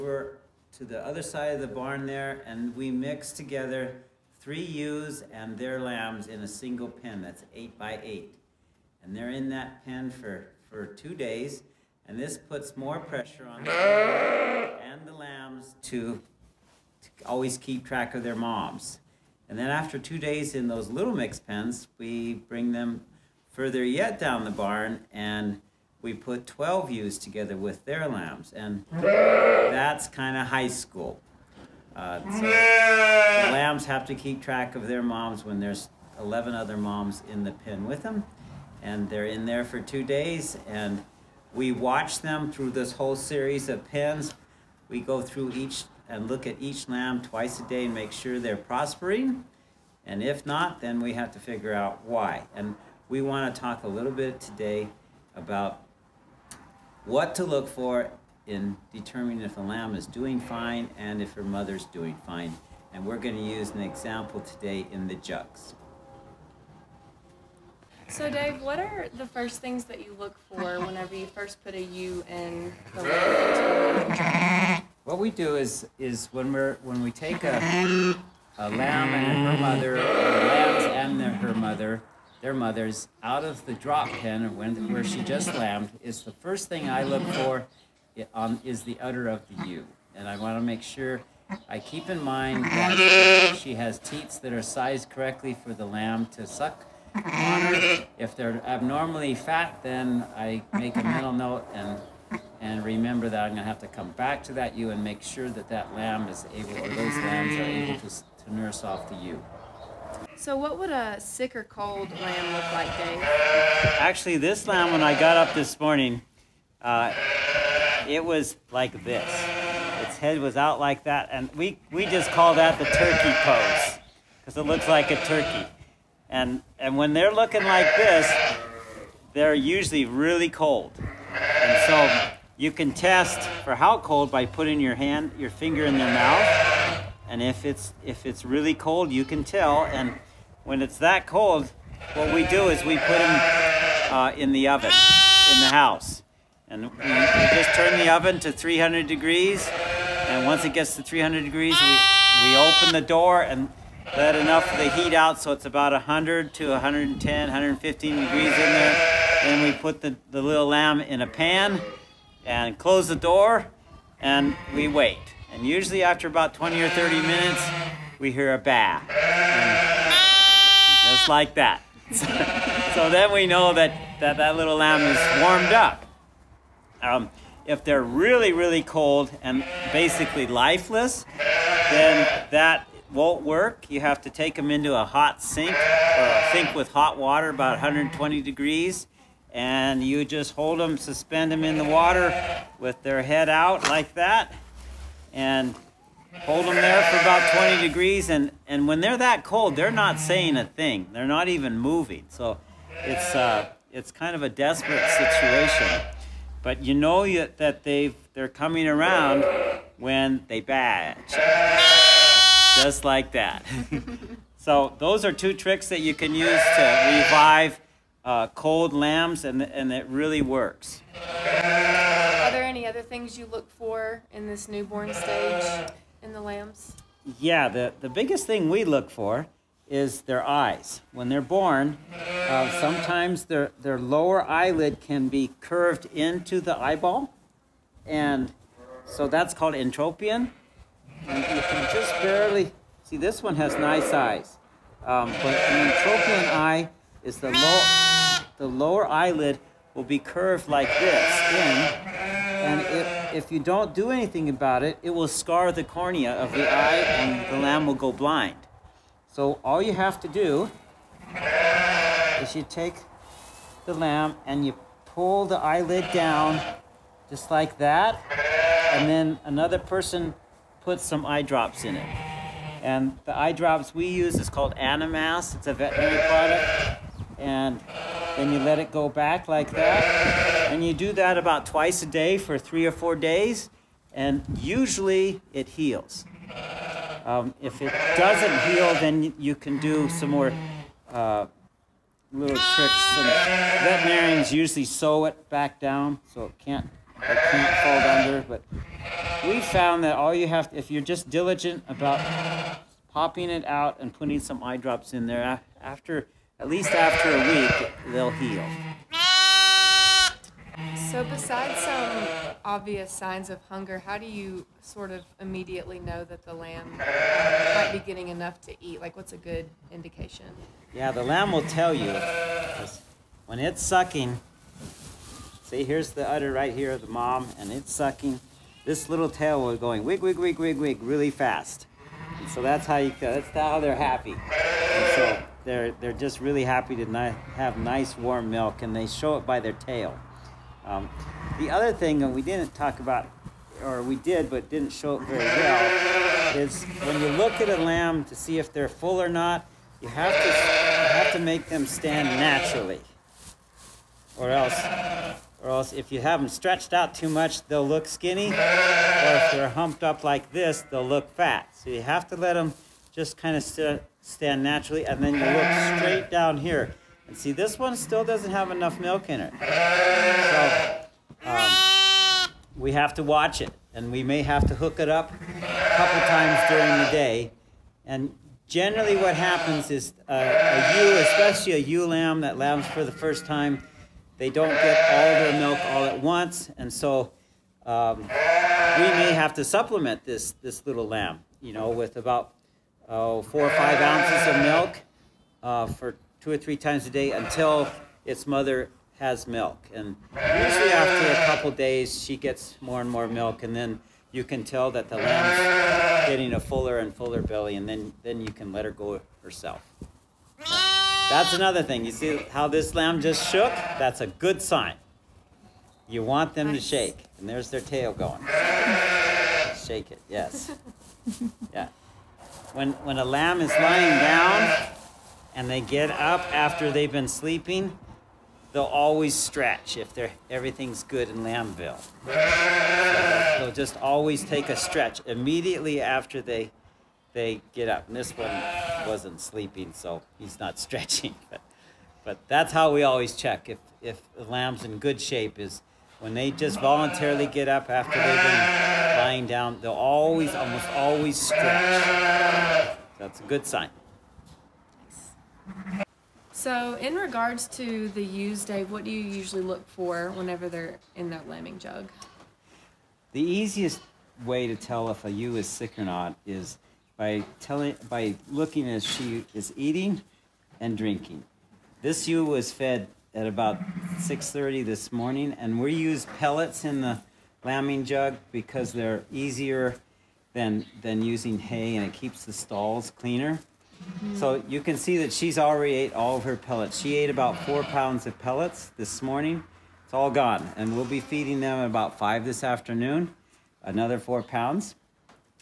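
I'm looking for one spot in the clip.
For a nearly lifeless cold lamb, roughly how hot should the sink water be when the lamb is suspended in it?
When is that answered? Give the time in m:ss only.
3:07.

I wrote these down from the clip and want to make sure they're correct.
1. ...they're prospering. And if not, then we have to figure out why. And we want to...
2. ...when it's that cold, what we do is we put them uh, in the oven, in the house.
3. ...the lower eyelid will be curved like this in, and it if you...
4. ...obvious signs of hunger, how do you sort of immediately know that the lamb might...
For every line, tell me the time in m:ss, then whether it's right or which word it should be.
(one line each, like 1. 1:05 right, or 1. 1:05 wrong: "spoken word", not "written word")
1. 0:48 right
2. 2:20 right
3. 4:08 right
4. 5:12 right.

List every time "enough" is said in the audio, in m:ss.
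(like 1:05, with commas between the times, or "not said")
2:34, 5:18, 6:08.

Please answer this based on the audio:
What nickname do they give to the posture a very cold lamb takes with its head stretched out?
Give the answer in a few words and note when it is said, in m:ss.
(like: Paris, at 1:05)
turkey pose, at 2:02.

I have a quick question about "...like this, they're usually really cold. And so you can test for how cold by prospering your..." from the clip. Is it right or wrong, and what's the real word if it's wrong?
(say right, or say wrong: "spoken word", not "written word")
wrong: "putting", not "prospering".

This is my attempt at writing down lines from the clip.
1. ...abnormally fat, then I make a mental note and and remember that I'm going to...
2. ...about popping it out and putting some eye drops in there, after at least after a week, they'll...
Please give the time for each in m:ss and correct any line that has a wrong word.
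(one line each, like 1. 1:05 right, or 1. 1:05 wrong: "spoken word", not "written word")
1. 1:38 right
2. 5:01 right.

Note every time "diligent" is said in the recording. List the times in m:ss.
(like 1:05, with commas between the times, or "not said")
5:01.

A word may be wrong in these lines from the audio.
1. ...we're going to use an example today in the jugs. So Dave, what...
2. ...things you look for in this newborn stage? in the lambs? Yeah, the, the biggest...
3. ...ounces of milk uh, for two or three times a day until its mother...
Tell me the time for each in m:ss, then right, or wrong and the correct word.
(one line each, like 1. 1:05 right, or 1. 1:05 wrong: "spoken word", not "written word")
1. 1:03 right
2. 3:43 right
3. 6:34 right.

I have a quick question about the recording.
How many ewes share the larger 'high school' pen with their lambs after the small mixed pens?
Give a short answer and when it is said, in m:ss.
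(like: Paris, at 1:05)
12, at 0:26.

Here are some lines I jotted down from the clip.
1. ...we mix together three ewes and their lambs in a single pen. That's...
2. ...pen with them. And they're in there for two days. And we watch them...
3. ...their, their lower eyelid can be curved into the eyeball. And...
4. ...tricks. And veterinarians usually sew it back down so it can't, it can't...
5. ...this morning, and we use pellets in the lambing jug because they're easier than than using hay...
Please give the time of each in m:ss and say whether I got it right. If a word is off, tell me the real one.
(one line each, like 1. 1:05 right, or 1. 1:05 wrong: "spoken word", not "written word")
1. 0:02 right
2. 0:37 right
3. 3:53 right
4. 4:52 right
5. 7:54 right.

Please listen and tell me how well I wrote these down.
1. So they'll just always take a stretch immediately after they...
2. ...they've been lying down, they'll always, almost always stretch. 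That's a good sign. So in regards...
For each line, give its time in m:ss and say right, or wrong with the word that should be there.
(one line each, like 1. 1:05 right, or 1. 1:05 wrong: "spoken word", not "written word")
1. 7:12 right
2. 7:28 right.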